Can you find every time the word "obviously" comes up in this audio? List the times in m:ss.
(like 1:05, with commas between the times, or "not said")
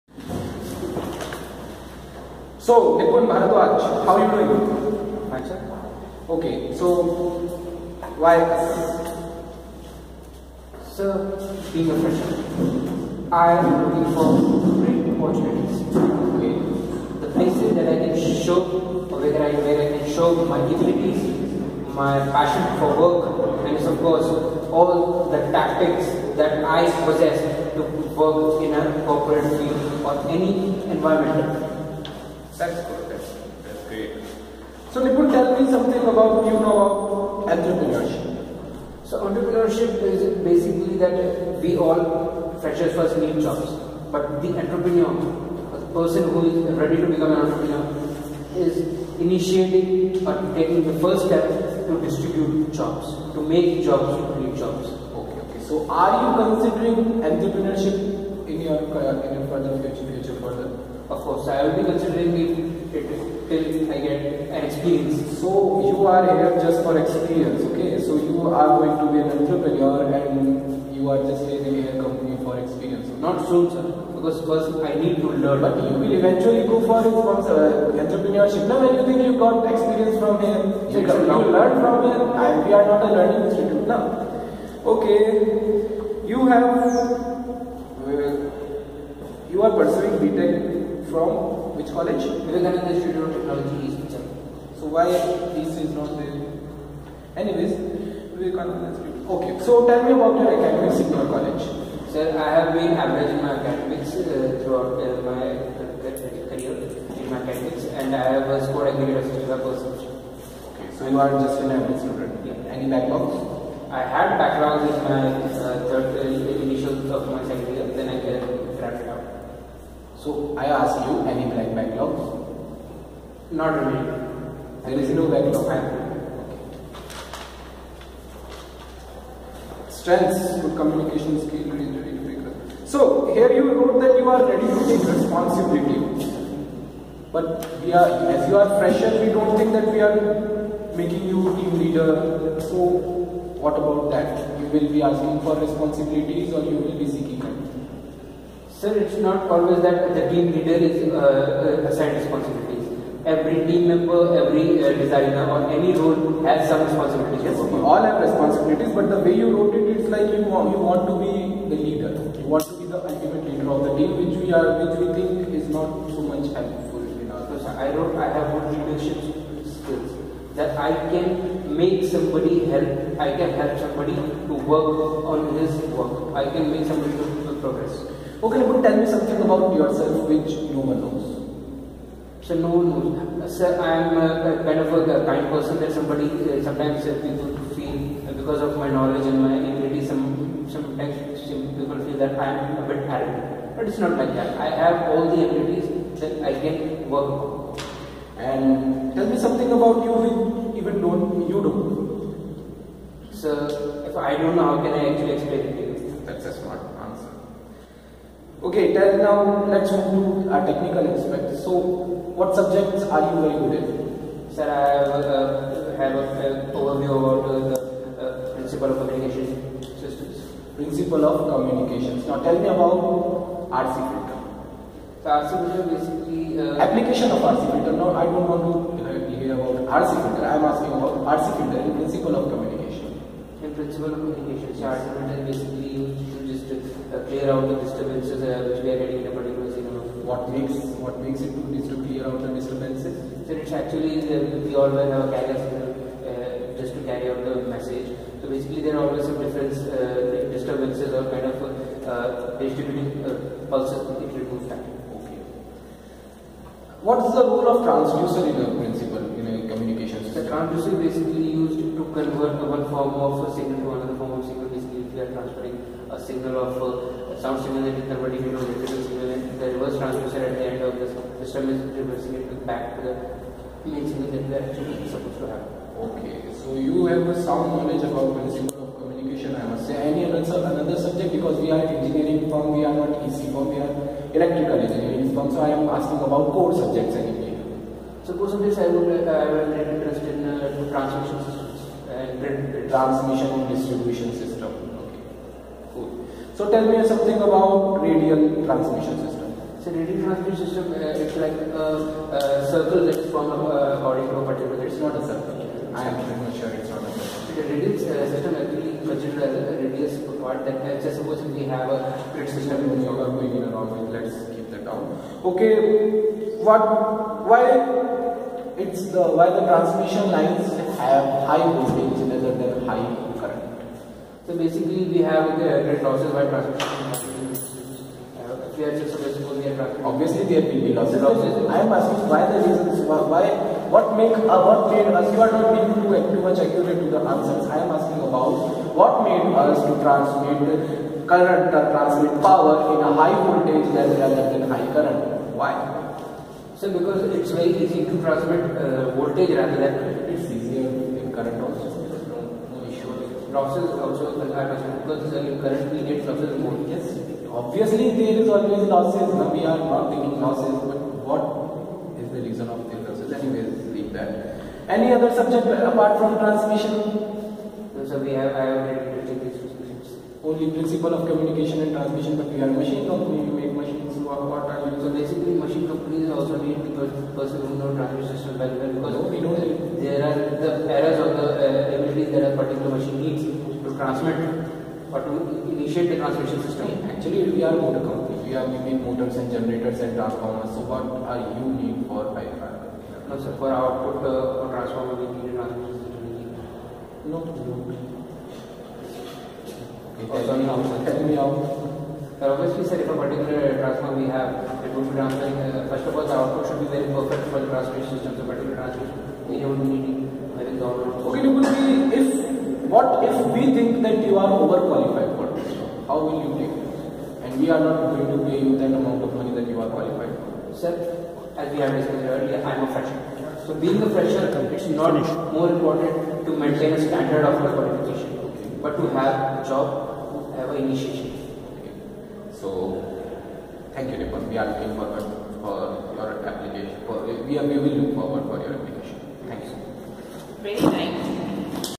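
5:30, 5:57, 6:42.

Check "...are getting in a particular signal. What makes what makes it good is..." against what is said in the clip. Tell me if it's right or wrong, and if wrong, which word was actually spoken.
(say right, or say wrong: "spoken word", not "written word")
right.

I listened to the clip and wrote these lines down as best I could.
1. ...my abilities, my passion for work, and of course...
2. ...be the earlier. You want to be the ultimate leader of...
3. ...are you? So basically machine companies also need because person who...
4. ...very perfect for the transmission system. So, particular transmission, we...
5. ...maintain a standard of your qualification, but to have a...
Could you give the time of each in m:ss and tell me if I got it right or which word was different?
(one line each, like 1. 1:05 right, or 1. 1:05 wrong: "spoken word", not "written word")
1. 0:20 right
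2. 2:41 wrong: "leader", not "earlier"
3. 6:14 right
4. 6:46 right
5. 7:06 right.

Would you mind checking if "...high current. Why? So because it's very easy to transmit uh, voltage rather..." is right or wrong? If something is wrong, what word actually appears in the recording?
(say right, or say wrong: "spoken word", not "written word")
right.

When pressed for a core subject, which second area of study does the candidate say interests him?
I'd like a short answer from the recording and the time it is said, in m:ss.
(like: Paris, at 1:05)
Transmission and distribution, at 4:52.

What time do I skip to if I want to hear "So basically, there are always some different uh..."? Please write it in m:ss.
4:08.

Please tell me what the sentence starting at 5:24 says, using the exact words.
So basically we have the rate losses by transmission.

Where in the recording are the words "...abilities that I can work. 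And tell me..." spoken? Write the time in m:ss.
3:15.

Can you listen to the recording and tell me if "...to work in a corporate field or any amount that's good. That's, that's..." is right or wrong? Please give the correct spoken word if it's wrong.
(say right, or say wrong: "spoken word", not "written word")
wrong: "environment", not "amount".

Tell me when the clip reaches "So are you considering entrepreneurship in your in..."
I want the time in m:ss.
0:55.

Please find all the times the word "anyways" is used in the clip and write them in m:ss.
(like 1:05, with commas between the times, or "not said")
1:37, 4:47, 6:03.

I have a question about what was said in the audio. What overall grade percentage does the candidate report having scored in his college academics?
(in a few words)
65%.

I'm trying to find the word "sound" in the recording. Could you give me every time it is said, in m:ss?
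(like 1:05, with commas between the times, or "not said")
4:27, 4:37.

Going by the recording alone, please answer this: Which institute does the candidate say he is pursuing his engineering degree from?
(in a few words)
Vivekananda Institute of Technology.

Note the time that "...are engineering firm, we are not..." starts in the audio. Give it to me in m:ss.
4:41.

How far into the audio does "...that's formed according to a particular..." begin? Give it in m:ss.
5:03.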